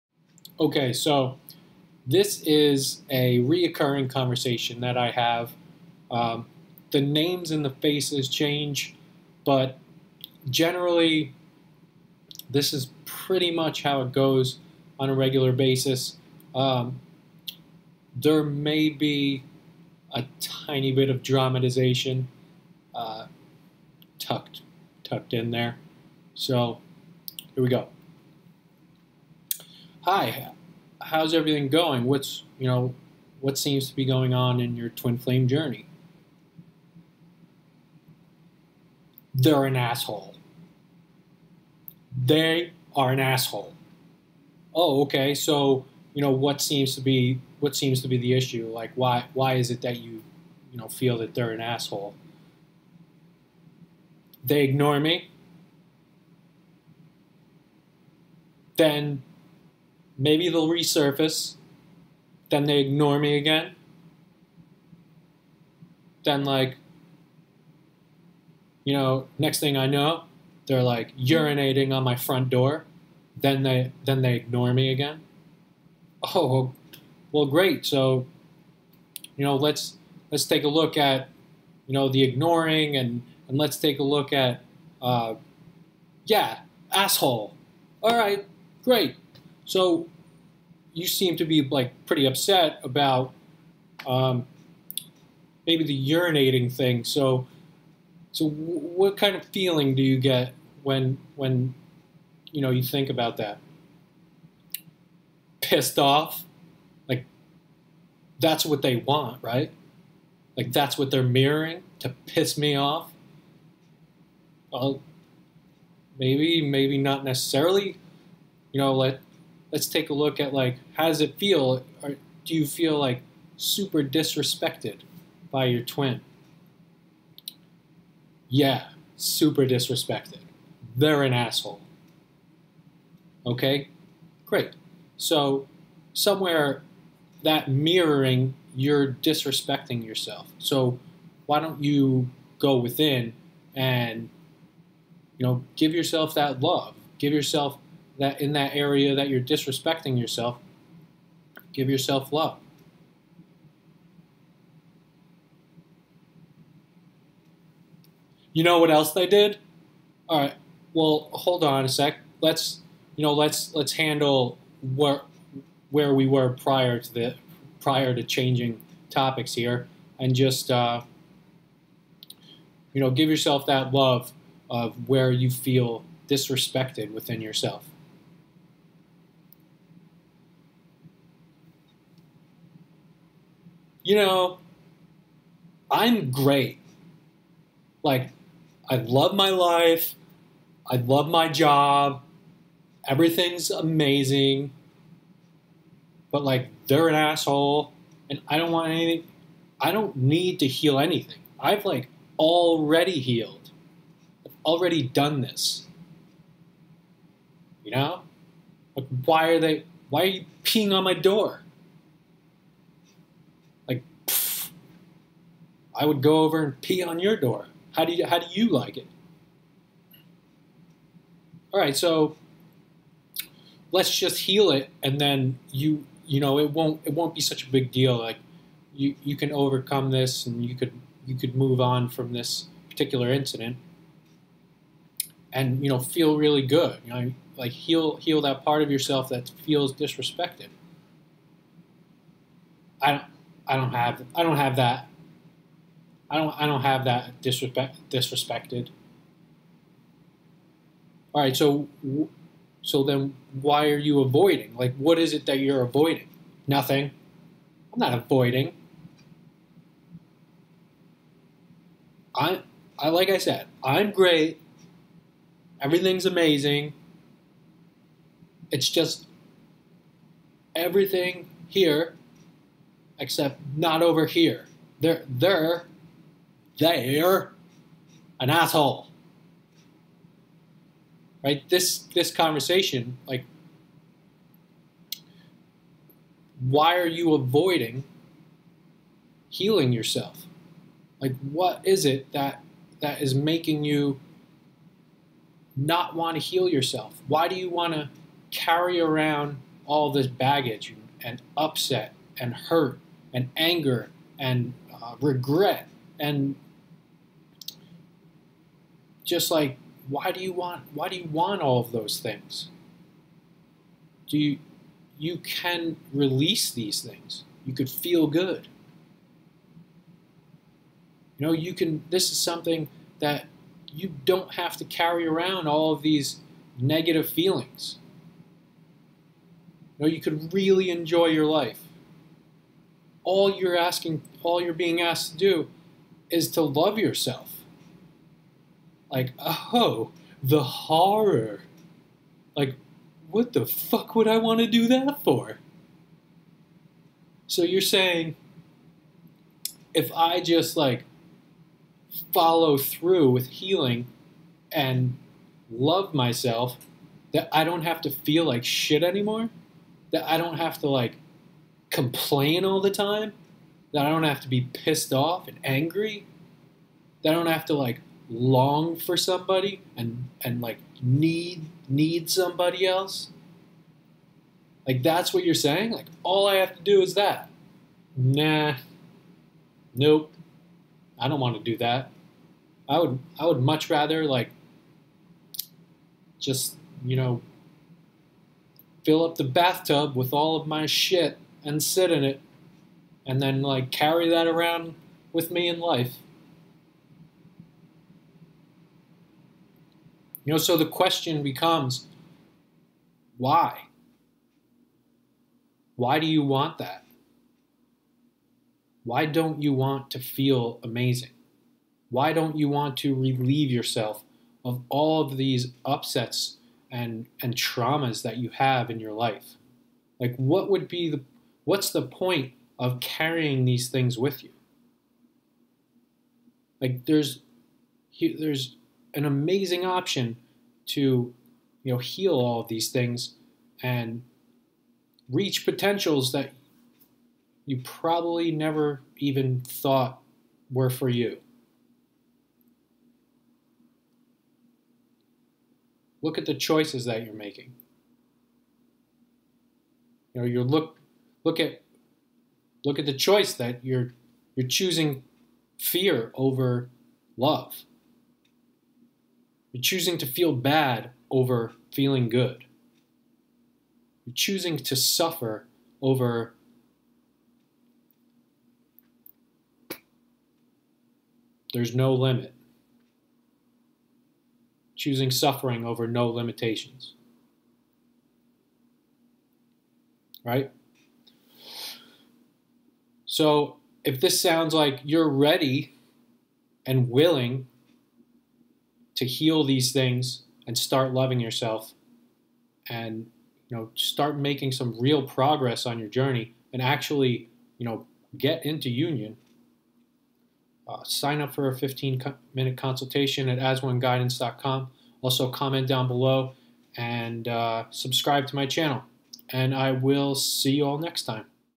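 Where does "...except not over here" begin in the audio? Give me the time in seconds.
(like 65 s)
273 s.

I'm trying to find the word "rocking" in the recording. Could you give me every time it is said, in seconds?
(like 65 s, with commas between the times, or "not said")
not said.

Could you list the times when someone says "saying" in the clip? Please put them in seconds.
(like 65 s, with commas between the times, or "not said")
347 s, 375 s.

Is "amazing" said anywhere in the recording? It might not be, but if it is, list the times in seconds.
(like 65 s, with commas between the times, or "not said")
193 s, 266 s, 410 s, 429 s.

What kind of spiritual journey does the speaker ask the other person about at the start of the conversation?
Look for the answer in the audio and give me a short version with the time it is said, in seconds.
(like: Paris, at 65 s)
Twin flame, at 34 s.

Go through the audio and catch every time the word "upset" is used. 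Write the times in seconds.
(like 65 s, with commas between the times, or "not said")
92 s, 301 s, 415 s.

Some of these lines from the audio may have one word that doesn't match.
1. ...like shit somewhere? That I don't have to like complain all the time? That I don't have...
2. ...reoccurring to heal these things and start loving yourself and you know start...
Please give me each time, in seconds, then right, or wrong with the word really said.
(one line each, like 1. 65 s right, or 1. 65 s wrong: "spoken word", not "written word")
1. 358 s wrong: "anymore", not "somewhere"
2. 487 s wrong: "willing", not "reoccurring".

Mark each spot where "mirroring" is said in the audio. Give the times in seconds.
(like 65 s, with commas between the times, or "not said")
111 s, 137 s.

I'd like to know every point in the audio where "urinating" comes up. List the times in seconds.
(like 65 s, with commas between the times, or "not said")
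71 s, 96 s.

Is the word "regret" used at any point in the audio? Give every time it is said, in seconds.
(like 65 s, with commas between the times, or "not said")
305 s.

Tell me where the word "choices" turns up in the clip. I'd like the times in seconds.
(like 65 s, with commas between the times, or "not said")
446 s, 453 s.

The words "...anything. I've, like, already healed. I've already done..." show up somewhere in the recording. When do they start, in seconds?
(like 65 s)
200 s.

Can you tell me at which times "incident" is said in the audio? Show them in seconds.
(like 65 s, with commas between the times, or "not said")
233 s.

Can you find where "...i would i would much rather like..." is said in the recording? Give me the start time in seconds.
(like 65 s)
382 s.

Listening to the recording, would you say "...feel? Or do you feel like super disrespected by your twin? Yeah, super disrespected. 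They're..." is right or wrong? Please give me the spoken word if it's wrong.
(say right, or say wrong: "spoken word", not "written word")
right.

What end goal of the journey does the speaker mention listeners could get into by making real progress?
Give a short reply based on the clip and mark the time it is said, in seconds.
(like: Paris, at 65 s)
Union, at 498 s.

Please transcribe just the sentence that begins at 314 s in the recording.
Do you you can release these things.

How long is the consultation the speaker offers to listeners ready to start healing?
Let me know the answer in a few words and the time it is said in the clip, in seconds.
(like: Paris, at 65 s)
15 minutes, at 501 s.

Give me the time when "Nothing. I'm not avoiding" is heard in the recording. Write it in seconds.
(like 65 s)
256 s.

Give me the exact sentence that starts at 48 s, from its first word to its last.
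Like why why is it that you, you know, feel that they're an asshole?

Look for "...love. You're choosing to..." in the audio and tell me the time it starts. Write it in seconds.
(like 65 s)
457 s.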